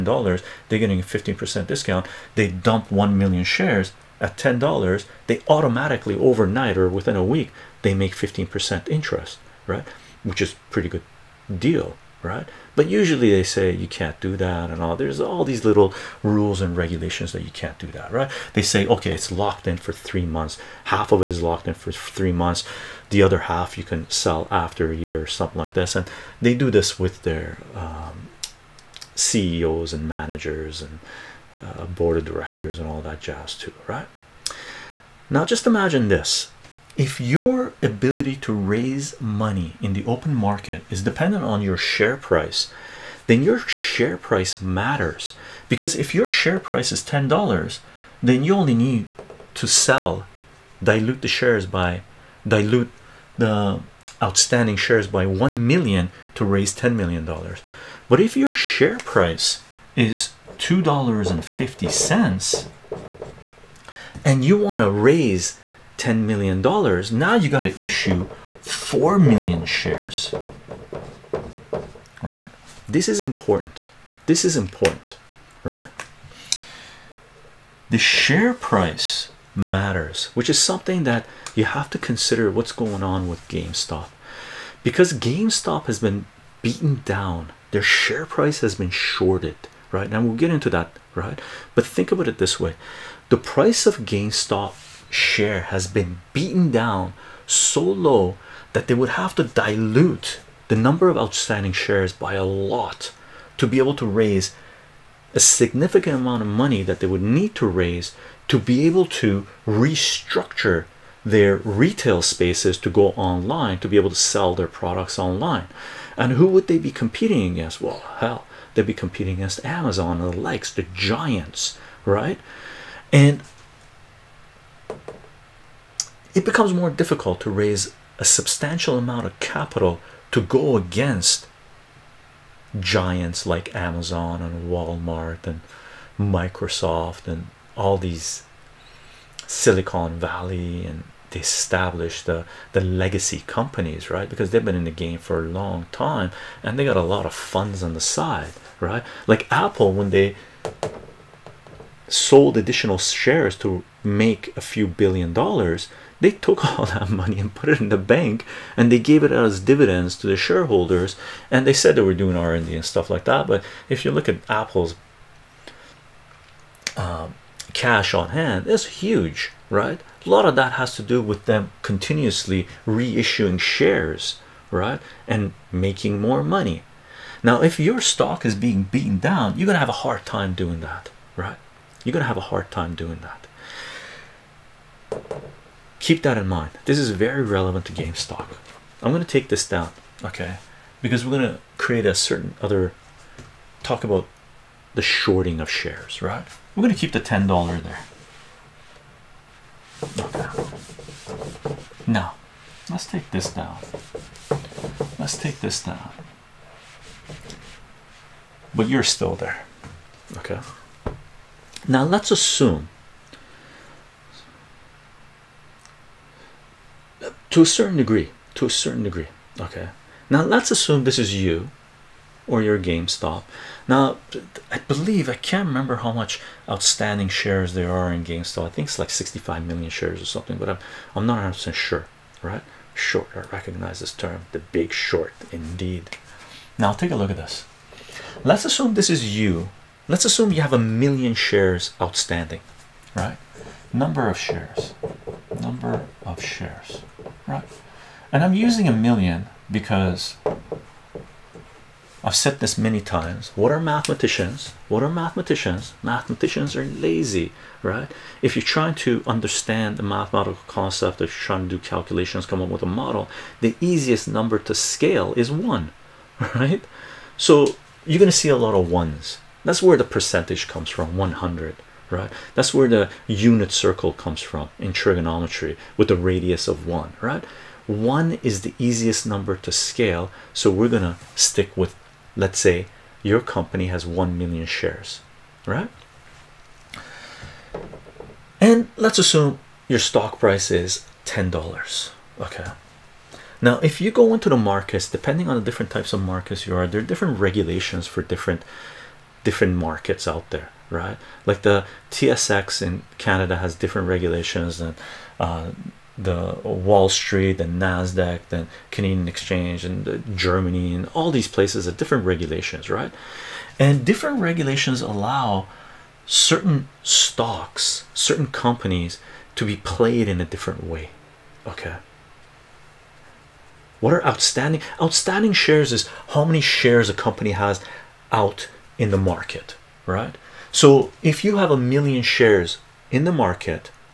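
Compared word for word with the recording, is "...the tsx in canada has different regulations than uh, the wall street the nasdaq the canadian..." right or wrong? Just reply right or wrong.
right.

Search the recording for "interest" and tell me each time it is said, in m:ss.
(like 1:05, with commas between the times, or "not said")
0:08.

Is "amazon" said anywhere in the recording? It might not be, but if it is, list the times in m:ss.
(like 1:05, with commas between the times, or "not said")
1:59, 2:13.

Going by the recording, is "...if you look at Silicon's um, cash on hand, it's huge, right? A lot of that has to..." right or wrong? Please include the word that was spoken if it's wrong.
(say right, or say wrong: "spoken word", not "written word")
wrong: "Apple", not "Silicon".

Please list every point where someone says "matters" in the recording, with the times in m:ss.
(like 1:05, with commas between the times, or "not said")
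0:44, 1:19.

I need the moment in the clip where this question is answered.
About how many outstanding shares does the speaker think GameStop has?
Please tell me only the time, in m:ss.
3:49.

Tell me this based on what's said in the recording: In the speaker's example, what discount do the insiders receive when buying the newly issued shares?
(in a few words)
15 percent.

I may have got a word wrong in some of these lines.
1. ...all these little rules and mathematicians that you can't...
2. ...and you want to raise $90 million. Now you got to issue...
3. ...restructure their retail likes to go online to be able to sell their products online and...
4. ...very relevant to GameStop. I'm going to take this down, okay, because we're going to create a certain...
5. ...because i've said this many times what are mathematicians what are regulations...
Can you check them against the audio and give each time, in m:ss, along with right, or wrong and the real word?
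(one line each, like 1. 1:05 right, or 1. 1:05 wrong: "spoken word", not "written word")
1. 0:15 wrong: "regulations", not "mathematicians"
2. 1:04 wrong: "10", not "90"
3. 1:49 wrong: "spaces", not "likes"
4. 3:07 right
5. 4:09 wrong: "mathematicians", not "regulations".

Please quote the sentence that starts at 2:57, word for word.
Now, if your stock is being beaten down, you're gonna have a hard time doing that, right?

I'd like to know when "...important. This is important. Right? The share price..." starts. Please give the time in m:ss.
1:13.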